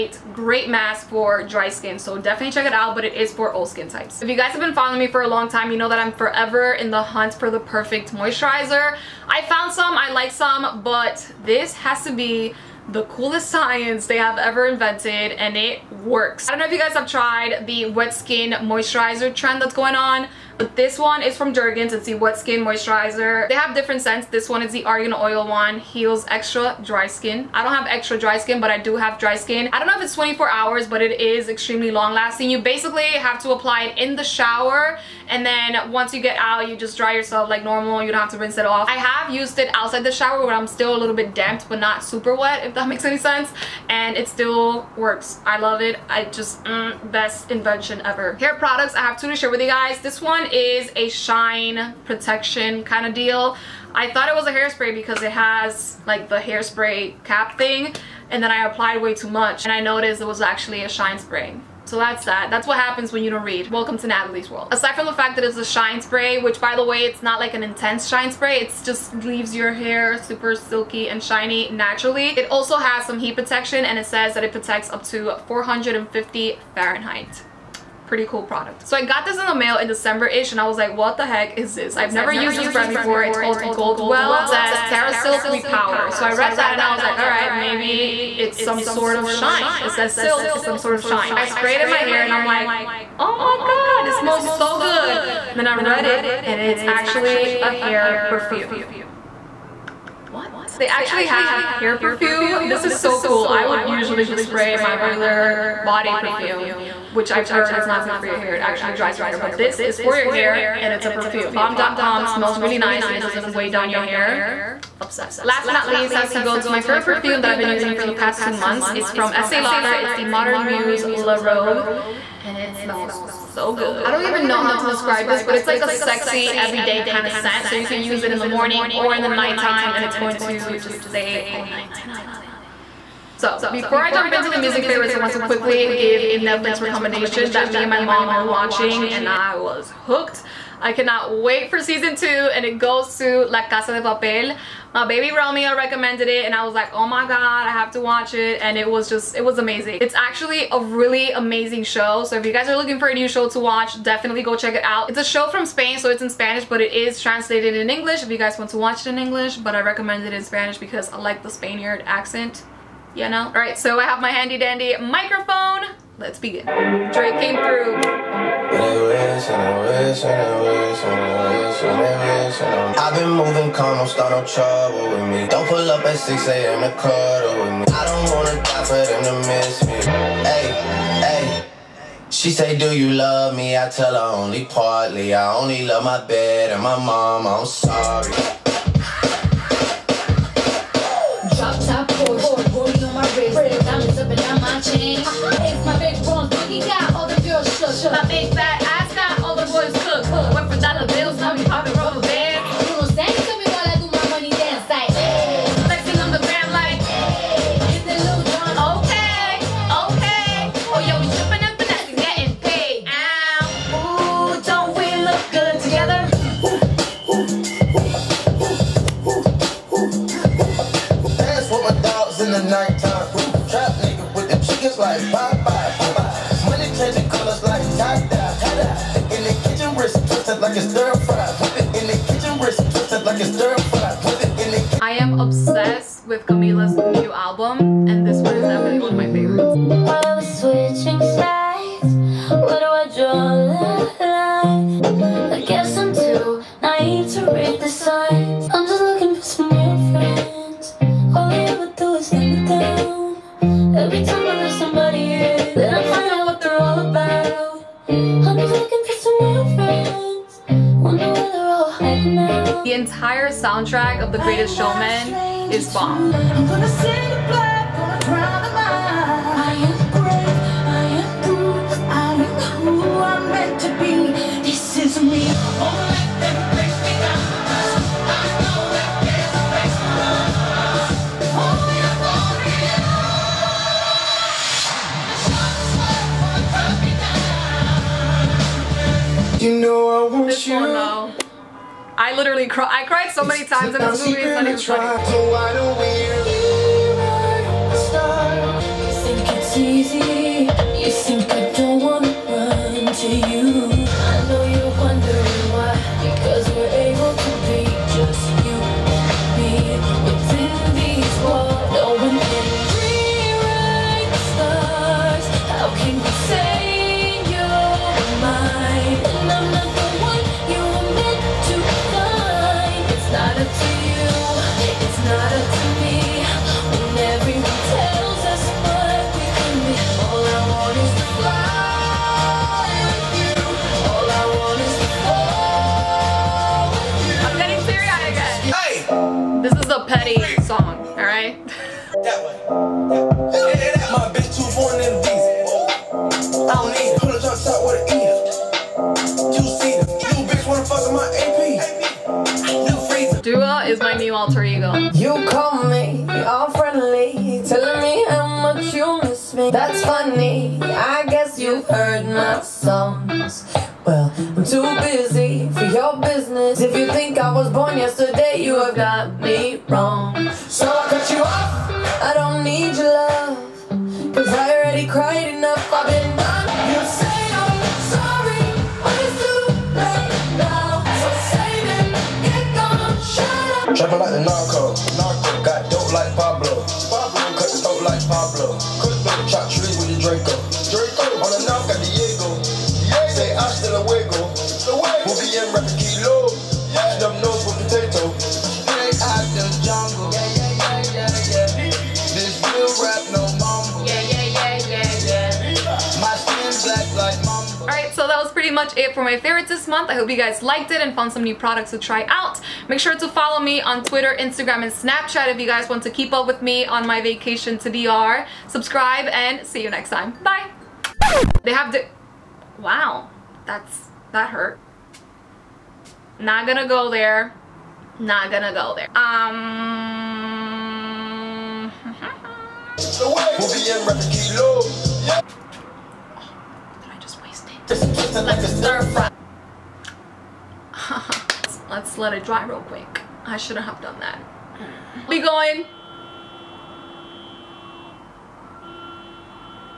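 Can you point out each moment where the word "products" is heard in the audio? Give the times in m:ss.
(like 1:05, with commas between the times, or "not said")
0:48, 1:18, 6:51.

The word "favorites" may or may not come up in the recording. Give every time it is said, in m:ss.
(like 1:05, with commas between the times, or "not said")
1:56, 2:14, 6:49.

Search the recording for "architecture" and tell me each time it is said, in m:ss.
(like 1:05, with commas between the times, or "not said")
not said.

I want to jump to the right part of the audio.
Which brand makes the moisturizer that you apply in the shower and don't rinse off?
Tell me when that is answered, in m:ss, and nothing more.
0:21.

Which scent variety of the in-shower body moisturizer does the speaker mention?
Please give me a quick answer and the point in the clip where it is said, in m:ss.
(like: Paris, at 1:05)
Argan Oil, at 0:24.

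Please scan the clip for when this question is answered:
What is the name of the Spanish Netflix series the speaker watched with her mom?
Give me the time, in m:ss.
2:23.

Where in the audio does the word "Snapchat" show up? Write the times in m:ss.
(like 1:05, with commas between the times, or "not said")
6:54.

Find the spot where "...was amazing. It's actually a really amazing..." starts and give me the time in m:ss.
2:29.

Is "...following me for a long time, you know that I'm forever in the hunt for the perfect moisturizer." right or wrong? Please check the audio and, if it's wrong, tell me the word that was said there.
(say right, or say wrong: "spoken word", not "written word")
right.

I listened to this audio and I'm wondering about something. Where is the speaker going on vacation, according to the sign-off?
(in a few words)
DR.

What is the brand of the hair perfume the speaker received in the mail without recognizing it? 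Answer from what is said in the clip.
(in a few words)
Goldwell.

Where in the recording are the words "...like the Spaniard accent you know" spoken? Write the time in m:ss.
2:41.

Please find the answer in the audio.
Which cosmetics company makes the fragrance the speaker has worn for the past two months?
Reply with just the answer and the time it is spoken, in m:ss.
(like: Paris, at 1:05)
Estee Lauder, at 1:59.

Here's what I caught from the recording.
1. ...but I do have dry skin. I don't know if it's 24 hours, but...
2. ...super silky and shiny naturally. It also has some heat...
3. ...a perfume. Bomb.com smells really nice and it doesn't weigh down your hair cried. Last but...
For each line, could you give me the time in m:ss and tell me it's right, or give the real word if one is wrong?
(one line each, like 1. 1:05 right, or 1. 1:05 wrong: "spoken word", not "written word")
1. 0:28 right
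2. 1:10 right
3. 1:51 wrong: "obsessed", not "cried".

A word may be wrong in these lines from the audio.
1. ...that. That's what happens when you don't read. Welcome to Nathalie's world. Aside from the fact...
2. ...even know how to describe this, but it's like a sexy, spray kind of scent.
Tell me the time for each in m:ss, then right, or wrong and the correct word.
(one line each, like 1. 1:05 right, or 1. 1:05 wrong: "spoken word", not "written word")
1. 1:02 right
2. 2:04 wrong: "everyday", not "spray".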